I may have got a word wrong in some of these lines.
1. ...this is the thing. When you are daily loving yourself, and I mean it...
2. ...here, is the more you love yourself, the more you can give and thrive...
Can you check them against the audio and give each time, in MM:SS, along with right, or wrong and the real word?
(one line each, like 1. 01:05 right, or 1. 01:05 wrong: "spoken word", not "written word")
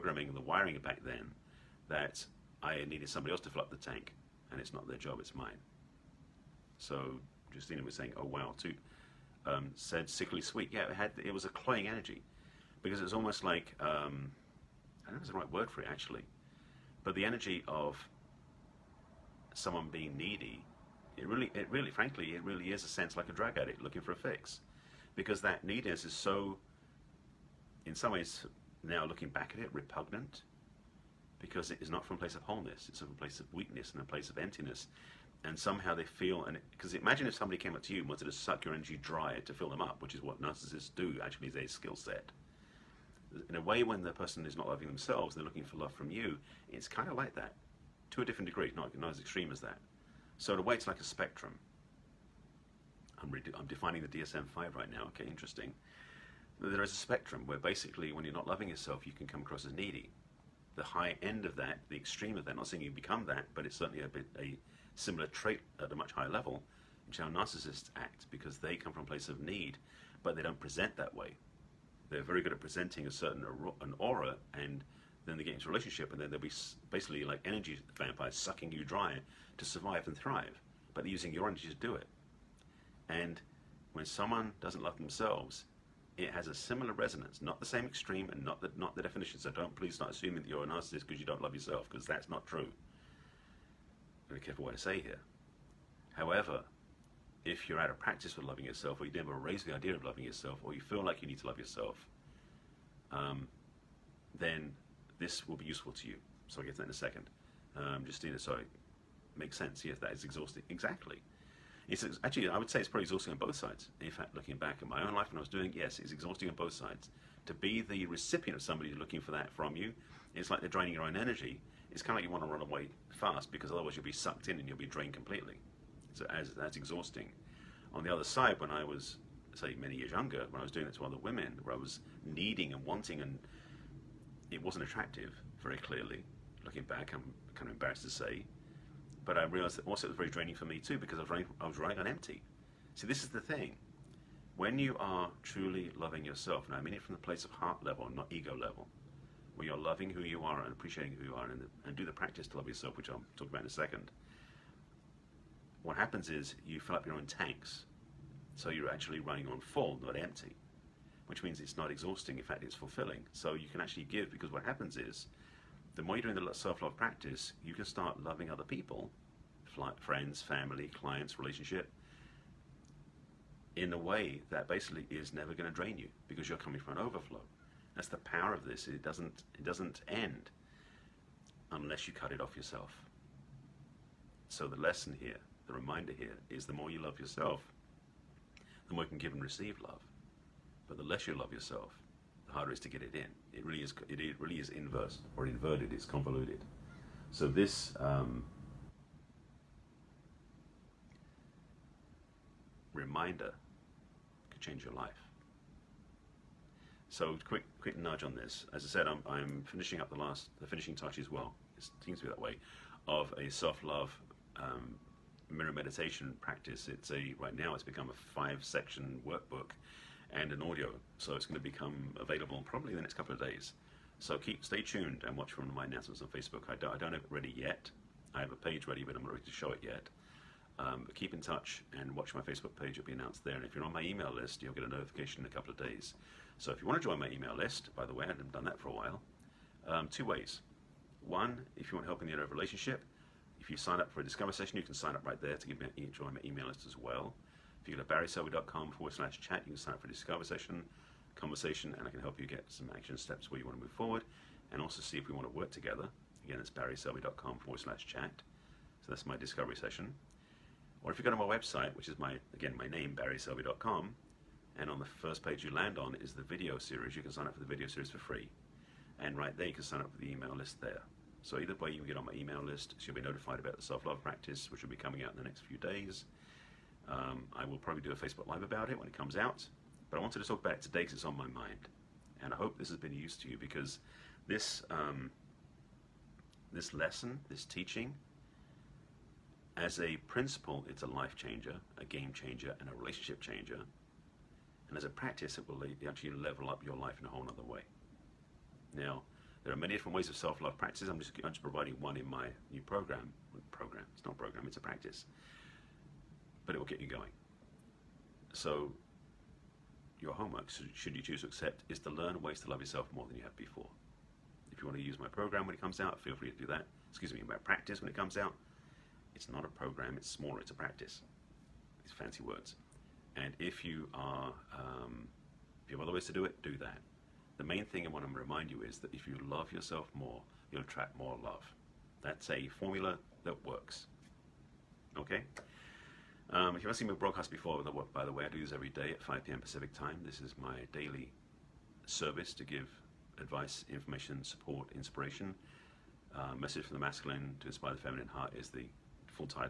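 1. 02:23 wrong: "truly", not "daily"
2. 03:06 wrong: "receive", not "thrive".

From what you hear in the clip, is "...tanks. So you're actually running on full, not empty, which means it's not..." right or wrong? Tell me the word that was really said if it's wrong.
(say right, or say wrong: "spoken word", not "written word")
right.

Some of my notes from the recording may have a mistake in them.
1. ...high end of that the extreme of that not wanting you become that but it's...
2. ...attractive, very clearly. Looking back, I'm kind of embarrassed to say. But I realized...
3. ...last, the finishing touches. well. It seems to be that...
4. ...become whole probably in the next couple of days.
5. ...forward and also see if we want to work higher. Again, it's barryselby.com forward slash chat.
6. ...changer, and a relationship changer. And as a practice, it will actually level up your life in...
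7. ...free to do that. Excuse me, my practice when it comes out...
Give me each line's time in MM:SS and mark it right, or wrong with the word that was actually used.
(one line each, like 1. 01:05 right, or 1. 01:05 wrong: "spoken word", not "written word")
1. 01:00 wrong: "saying", not "wanting"
2. 02:14 right
3. 03:30 right
4. 03:41 wrong: "available", not "whole"
5. 04:13 wrong: "together", not "higher"
6. 04:52 right
7. 05:16 right.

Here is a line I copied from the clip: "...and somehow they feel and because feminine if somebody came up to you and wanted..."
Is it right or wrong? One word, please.
wrong.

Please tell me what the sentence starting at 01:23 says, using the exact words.
And when someone doesn't love themselves, it has a similar resonance, not the same extreme and not the, not the definition.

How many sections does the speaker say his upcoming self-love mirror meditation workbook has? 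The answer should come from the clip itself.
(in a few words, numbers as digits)
5.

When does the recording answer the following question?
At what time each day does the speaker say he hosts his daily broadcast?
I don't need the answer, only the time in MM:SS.
05:39.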